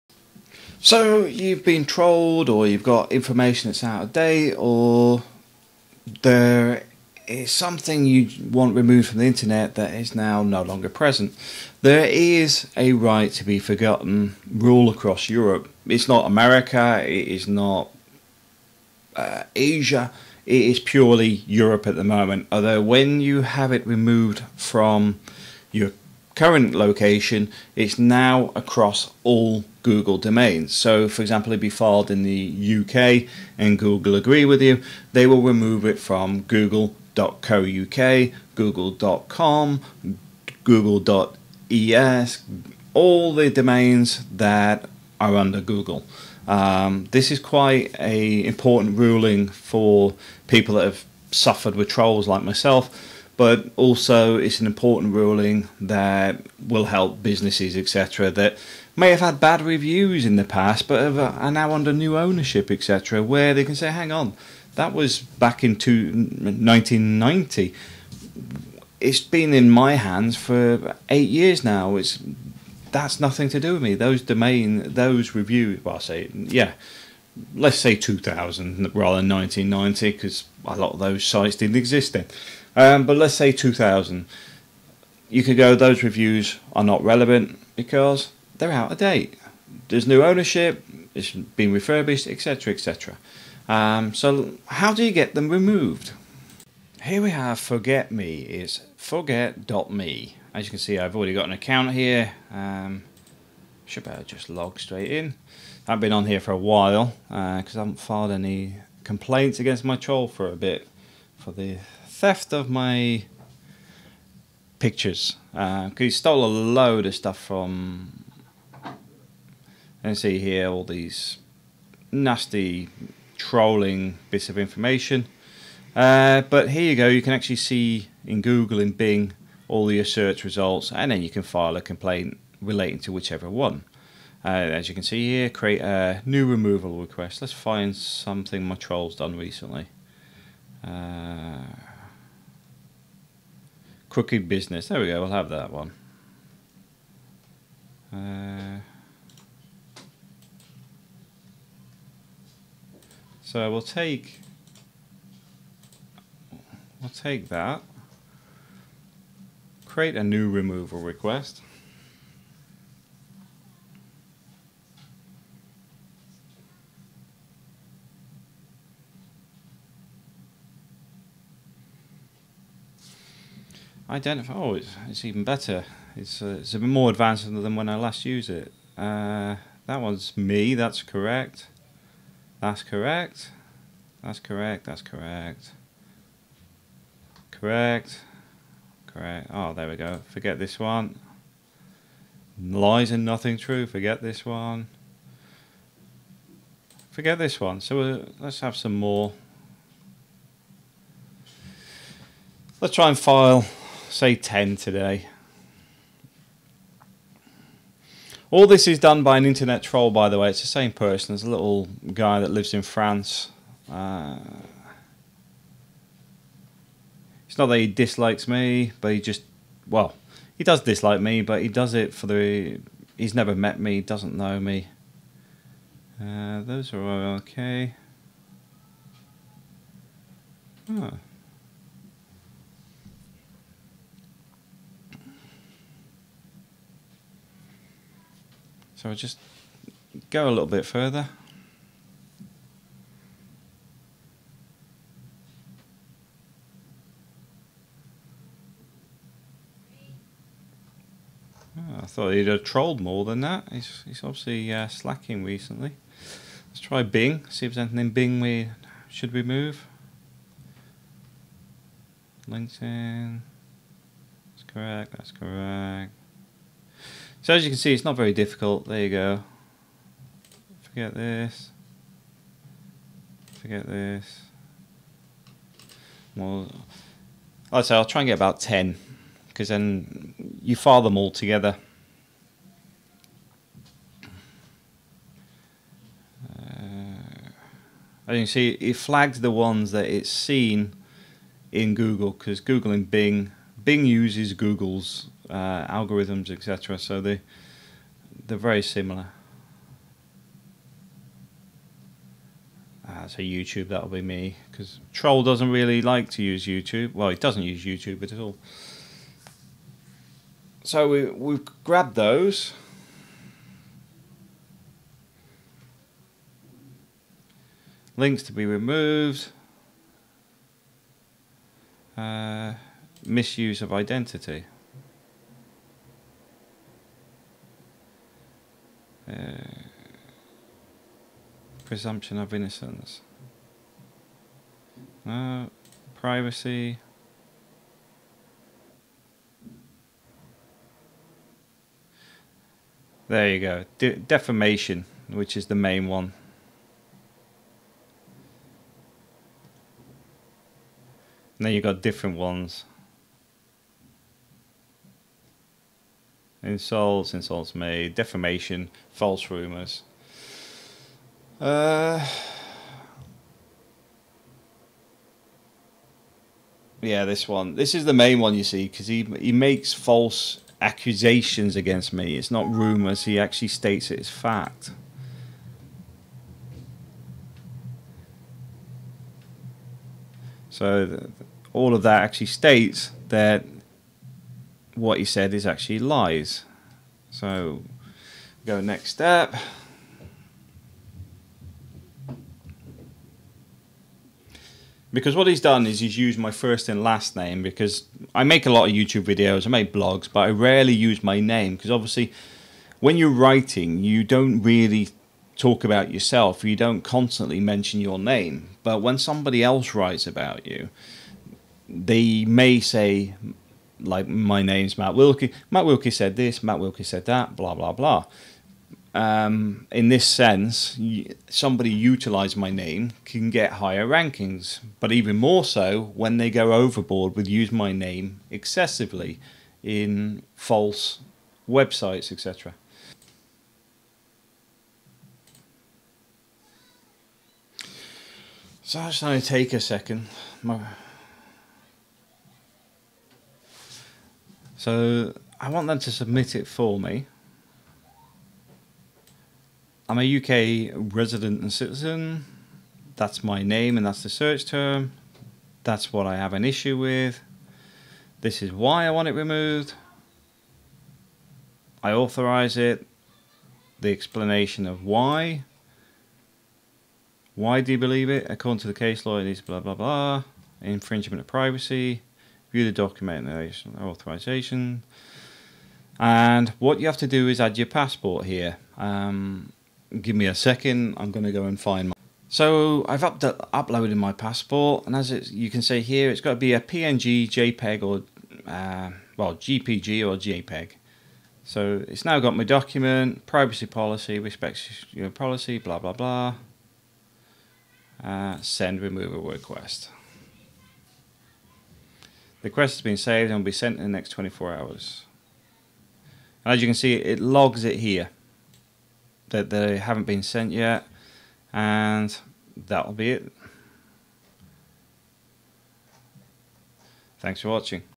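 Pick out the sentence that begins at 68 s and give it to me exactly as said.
It's been in my hands for eight years now.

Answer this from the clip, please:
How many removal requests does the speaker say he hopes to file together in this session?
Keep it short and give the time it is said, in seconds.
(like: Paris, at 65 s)
10, at 204 s.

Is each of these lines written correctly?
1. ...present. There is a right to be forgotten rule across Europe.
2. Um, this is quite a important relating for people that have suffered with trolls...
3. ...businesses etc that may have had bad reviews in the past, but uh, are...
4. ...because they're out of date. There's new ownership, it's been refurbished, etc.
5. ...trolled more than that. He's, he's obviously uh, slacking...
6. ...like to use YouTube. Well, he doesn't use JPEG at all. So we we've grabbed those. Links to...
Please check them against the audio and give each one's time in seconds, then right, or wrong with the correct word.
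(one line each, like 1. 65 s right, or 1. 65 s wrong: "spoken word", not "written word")
1. 10 s right
2. 46 s wrong: "ruling", not "relating"
3. 57 s right
4. 87 s right
5. 252 s right
6. 306 s wrong: "YouTube", not "JPEG".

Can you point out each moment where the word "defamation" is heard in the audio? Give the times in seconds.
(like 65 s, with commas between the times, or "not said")
344 s, 358 s.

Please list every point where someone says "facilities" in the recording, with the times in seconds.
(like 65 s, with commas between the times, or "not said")
not said.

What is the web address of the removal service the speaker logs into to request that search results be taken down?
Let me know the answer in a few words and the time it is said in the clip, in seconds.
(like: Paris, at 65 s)
forget.me, at 98 s.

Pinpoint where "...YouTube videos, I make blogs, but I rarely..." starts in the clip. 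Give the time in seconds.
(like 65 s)
398 s.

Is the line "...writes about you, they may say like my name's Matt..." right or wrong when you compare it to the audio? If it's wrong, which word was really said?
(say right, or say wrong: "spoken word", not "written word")
right.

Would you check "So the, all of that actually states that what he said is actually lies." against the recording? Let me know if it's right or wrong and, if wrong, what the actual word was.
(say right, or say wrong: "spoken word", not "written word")
right.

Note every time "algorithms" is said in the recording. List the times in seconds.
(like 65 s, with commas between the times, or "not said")
295 s.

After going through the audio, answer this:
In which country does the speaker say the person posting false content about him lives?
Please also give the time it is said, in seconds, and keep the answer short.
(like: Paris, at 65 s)
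France, at 212 s.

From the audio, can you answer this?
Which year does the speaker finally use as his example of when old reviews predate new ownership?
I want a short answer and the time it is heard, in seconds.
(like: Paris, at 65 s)
2000, at 77 s.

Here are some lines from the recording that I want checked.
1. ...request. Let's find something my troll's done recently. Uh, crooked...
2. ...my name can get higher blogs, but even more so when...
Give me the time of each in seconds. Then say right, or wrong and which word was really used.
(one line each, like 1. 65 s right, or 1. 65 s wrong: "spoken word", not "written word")
1. 136 s right
2. 422 s wrong: "rankings", not "blogs".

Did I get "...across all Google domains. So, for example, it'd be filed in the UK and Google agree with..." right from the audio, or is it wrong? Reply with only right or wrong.
right.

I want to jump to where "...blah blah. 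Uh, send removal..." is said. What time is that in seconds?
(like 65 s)
495 s.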